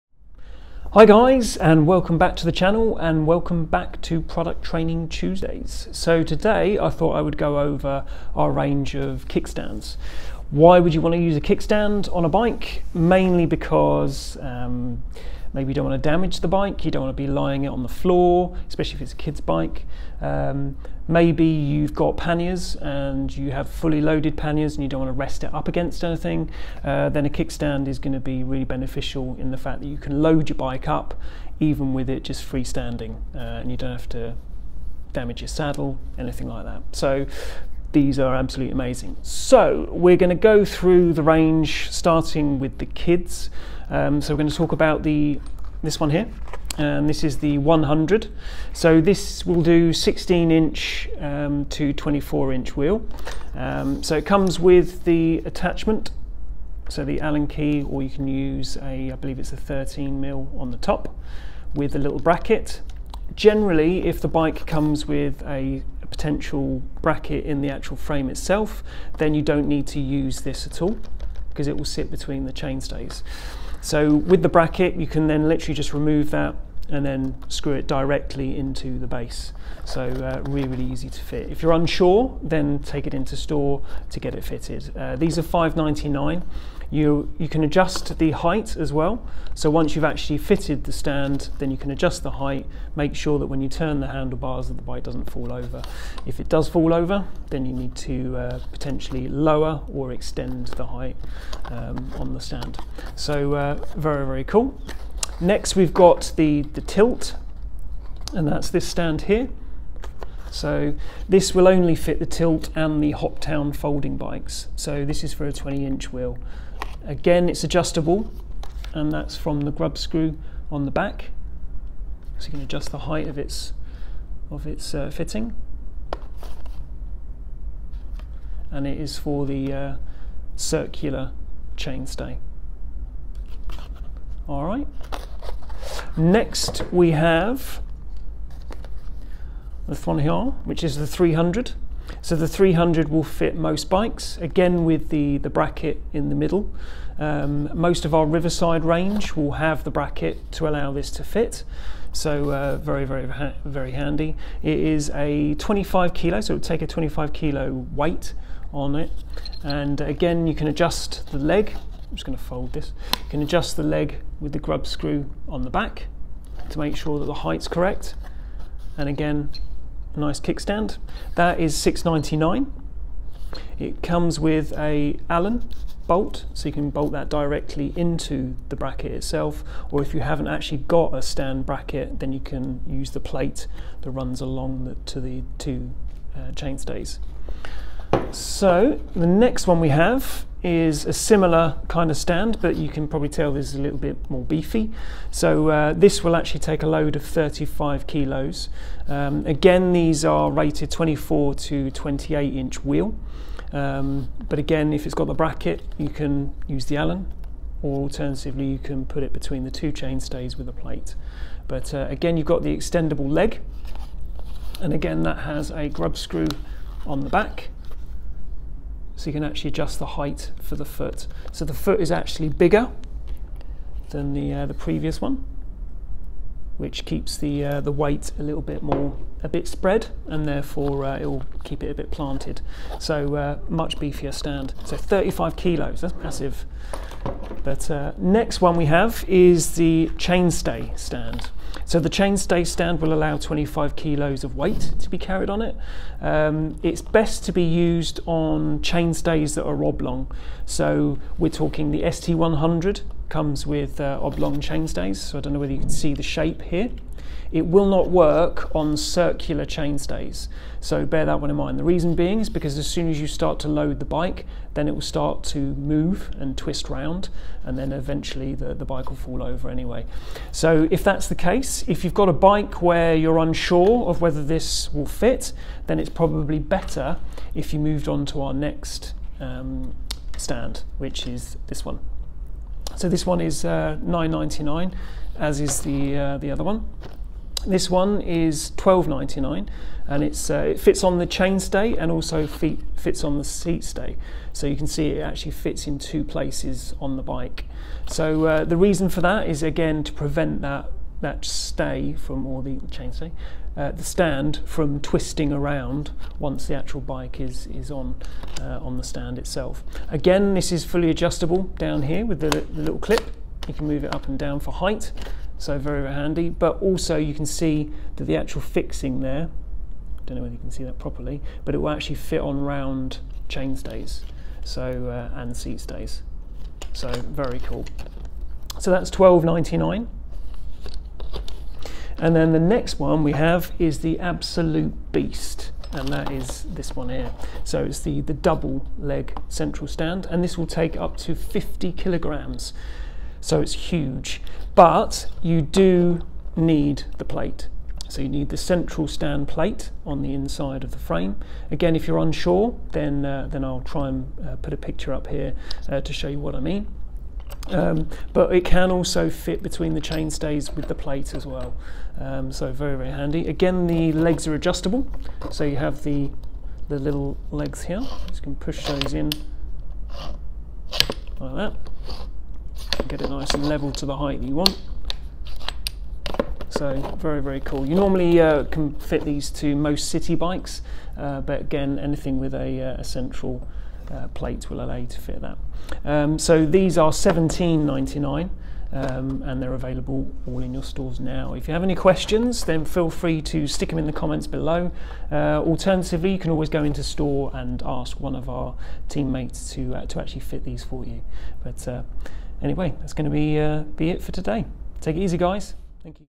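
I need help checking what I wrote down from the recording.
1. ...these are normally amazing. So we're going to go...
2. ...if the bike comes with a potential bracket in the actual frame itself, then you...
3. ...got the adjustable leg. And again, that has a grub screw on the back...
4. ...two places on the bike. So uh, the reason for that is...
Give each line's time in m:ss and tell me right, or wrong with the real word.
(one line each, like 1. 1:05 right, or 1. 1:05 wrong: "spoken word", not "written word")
1. 0:37 wrong: "absolutely", not "normally"
2. 1:04 right
3. 3:32 wrong: "extendable", not "adjustable"
4. 4:55 right.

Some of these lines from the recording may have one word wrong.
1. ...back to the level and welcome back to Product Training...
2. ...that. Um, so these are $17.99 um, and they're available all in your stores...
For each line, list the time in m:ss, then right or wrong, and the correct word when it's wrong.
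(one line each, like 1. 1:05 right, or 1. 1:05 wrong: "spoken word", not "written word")
1. 0:02 wrong: "channel", not "level"
2. 6:25 right.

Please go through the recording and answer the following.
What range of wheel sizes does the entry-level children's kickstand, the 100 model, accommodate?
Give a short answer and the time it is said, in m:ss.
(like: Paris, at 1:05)
16 to 24 inch, at 0:49.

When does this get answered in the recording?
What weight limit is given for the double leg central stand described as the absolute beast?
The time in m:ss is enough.
5:41.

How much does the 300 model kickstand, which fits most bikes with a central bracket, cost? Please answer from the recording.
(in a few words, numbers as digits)
6.99.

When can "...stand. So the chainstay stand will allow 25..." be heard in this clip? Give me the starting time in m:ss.
4:00.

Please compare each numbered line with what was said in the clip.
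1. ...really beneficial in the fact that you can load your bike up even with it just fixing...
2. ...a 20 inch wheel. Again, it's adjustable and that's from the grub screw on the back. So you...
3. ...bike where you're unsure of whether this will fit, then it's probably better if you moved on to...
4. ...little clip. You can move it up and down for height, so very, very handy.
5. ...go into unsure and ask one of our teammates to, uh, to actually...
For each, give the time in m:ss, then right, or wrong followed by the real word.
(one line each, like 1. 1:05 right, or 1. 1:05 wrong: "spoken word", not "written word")
1. 0:28 wrong: "freestanding", not "fixing"
2. 1:55 right
3. 4:32 right
4. 5:12 right
5. 6:36 wrong: "store", not "unsure".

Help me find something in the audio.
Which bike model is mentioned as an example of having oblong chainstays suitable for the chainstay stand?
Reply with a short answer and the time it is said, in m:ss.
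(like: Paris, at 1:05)
ST100, at 4:12.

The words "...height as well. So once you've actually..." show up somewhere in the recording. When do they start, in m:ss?
1:28.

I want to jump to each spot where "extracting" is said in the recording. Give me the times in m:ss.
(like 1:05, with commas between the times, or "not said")
not said.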